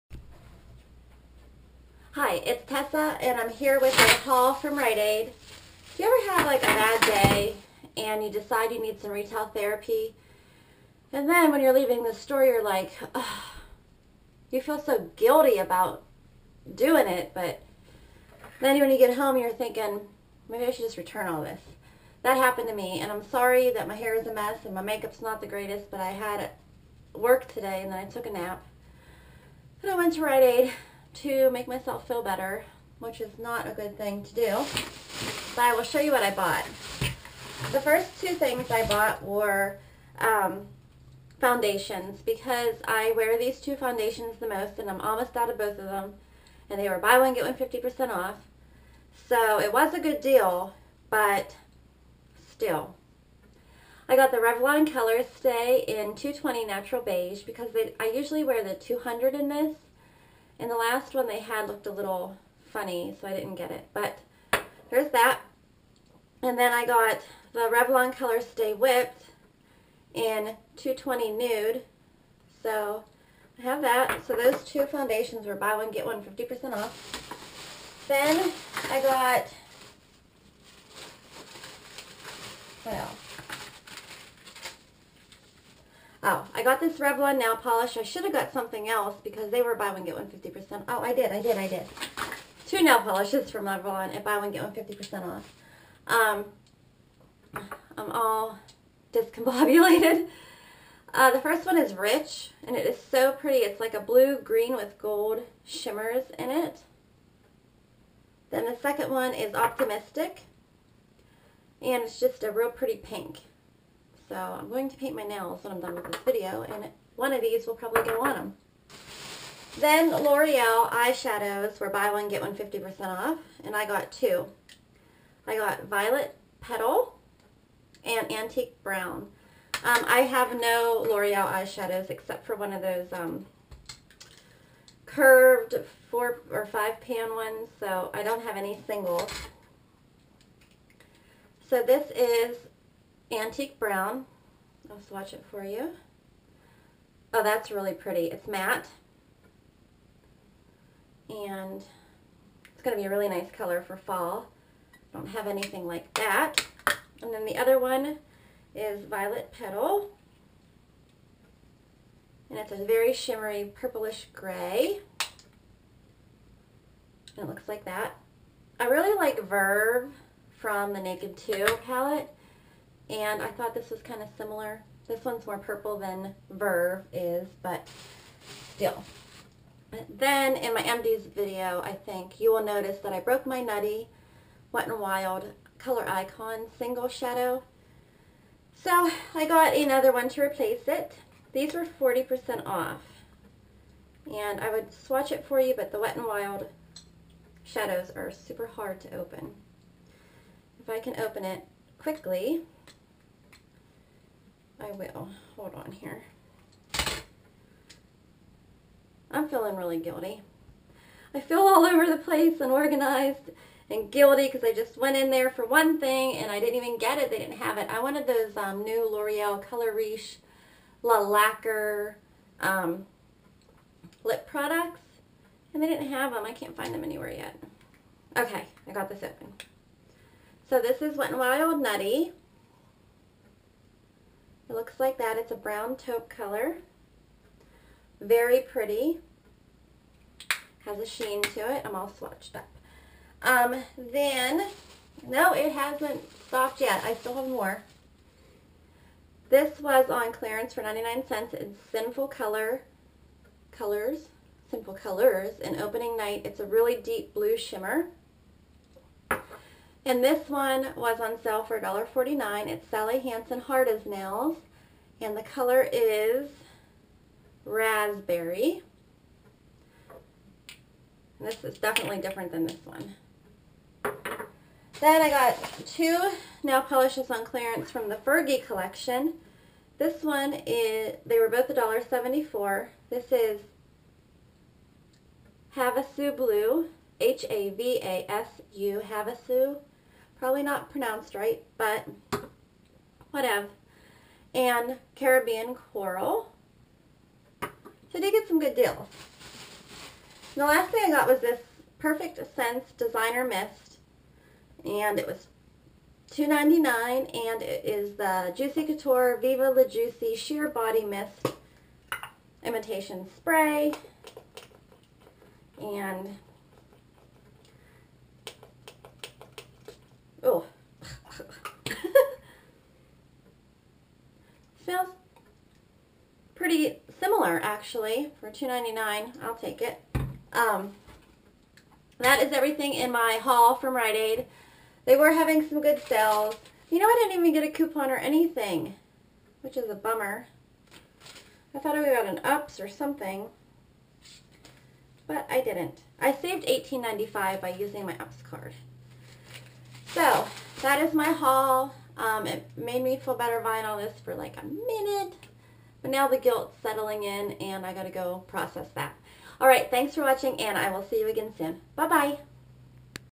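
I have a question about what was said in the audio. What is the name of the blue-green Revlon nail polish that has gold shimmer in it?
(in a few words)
Rich.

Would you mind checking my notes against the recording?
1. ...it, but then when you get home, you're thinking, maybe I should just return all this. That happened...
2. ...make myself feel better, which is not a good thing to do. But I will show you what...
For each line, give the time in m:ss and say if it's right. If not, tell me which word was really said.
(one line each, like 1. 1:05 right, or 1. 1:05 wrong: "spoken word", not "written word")
1. 0:17 right
2. 0:31 right.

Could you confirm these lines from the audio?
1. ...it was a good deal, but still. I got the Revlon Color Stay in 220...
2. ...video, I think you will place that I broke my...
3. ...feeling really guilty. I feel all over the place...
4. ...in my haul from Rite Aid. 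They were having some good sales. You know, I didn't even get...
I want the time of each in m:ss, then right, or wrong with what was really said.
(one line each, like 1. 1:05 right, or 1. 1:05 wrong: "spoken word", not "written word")
1. 0:49 right
2. 3:01 wrong: "notice", not "place"
3. 3:29 right
4. 5:32 right.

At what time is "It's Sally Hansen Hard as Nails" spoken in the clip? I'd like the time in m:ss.
4:22.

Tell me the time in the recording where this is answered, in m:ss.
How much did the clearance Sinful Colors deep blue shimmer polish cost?
4:10.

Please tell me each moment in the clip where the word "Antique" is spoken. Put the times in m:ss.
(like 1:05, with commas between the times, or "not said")
2:08, 2:23.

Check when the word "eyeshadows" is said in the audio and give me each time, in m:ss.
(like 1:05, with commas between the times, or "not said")
2:00, 2:11.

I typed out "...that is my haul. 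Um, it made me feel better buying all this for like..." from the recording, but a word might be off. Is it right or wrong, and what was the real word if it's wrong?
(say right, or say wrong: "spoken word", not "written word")
right.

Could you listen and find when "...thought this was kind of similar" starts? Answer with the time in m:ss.
2:53.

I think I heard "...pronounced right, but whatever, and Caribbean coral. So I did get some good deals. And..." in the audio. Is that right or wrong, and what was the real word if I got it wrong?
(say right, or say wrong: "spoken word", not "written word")
right.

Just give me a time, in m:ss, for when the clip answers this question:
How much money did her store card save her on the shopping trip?
5:46.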